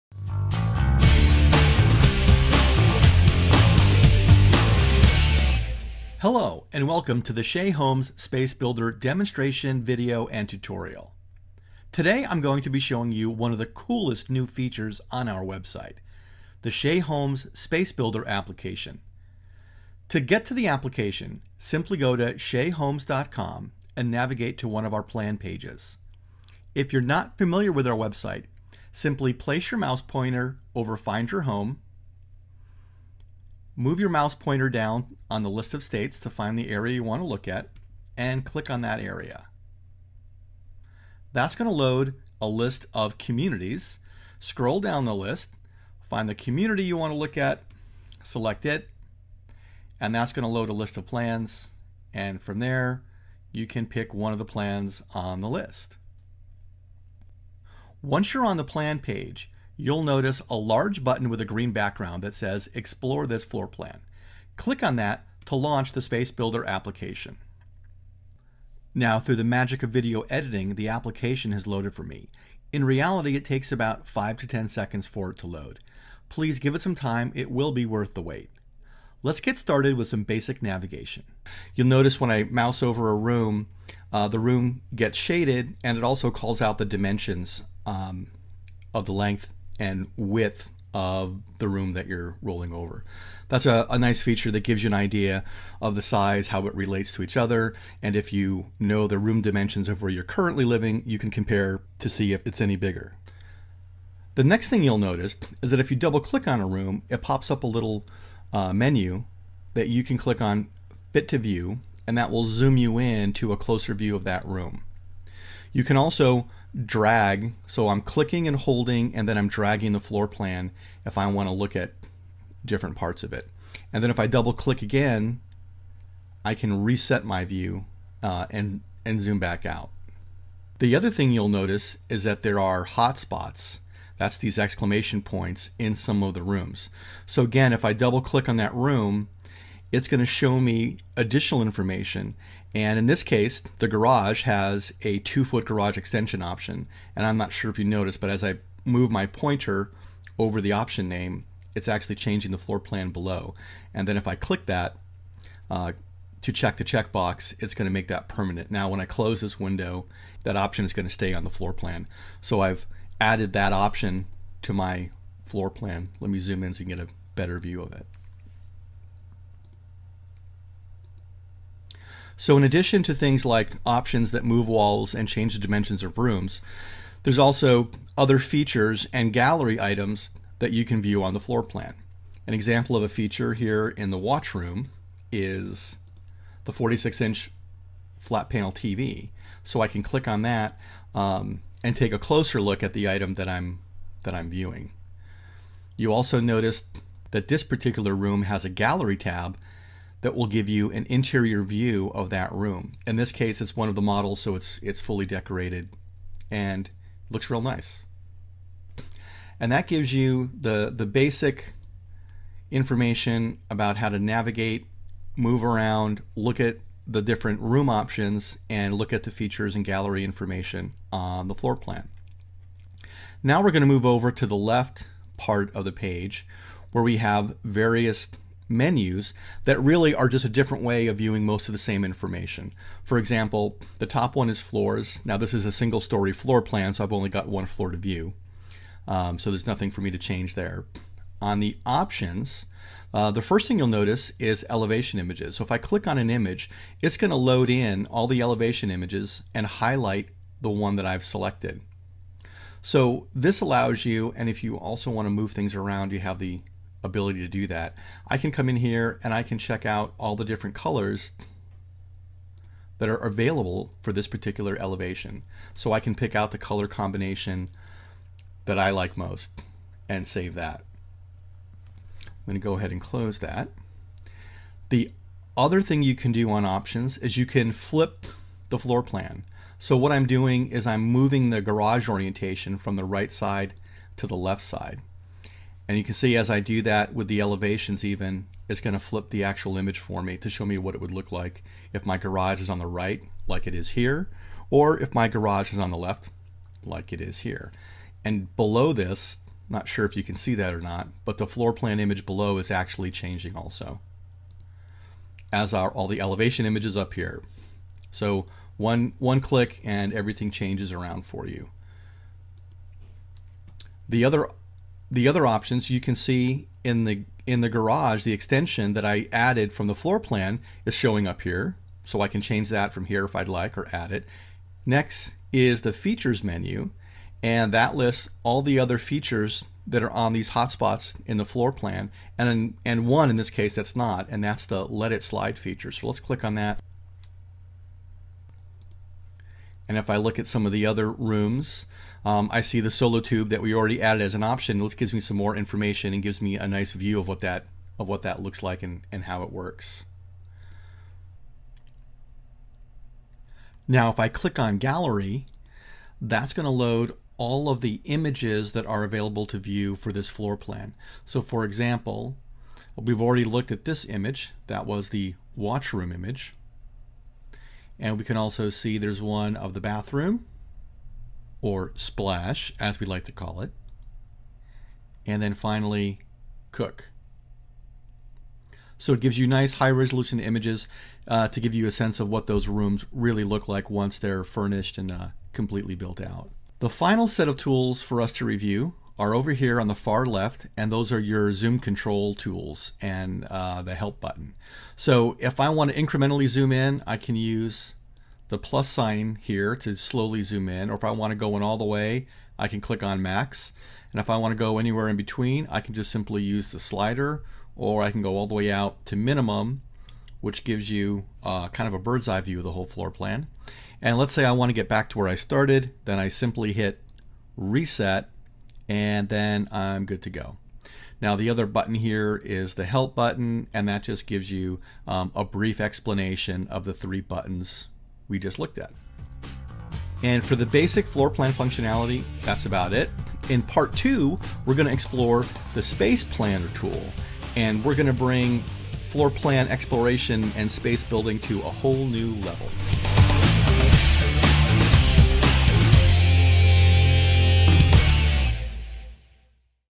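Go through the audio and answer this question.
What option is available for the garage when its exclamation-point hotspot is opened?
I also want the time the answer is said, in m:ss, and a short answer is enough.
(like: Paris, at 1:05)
two foot garage extension, at 2:25.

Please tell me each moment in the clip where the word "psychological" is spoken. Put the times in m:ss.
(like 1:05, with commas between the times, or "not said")
not said.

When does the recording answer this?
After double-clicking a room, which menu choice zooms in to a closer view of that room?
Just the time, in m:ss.
1:51.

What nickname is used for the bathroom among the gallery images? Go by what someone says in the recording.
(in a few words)
splash.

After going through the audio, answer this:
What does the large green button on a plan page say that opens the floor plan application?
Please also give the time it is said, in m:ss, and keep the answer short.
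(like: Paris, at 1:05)
Explore this floor plan, at 1:02.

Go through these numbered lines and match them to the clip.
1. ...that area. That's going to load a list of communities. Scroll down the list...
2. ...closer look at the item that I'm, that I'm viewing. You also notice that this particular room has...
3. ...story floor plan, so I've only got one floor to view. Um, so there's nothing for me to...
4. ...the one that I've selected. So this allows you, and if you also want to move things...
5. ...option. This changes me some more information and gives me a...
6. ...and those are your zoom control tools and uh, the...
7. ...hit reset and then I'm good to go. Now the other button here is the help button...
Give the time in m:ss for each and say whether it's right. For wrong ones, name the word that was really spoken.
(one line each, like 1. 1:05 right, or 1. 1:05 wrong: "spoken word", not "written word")
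1. 0:38 right
2. 3:12 right
3. 3:56 right
4. 4:10 right
5. 5:44 wrong: "gives", not "changes"
6. 6:30 right
7. 6:56 right.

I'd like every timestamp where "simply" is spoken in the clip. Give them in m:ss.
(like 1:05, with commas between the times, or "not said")
0:21, 0:28, 6:46, 6:56.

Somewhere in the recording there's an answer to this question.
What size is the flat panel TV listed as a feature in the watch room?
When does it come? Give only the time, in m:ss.
3:06.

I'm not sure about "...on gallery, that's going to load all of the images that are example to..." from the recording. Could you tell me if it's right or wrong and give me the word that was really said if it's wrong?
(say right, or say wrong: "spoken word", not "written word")
wrong: "available", not "example".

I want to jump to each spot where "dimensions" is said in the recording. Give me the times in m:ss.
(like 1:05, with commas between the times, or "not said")
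1:26, 1:39, 2:55.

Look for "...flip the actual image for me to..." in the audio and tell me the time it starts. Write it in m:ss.
4:48.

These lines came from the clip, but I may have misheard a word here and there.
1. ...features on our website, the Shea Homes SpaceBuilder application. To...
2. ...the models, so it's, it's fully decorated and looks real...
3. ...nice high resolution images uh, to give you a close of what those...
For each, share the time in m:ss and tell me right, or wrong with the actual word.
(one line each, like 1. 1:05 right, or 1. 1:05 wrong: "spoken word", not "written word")
1. 0:14 right
2. 3:23 right
3. 6:19 wrong: "sense", not "close".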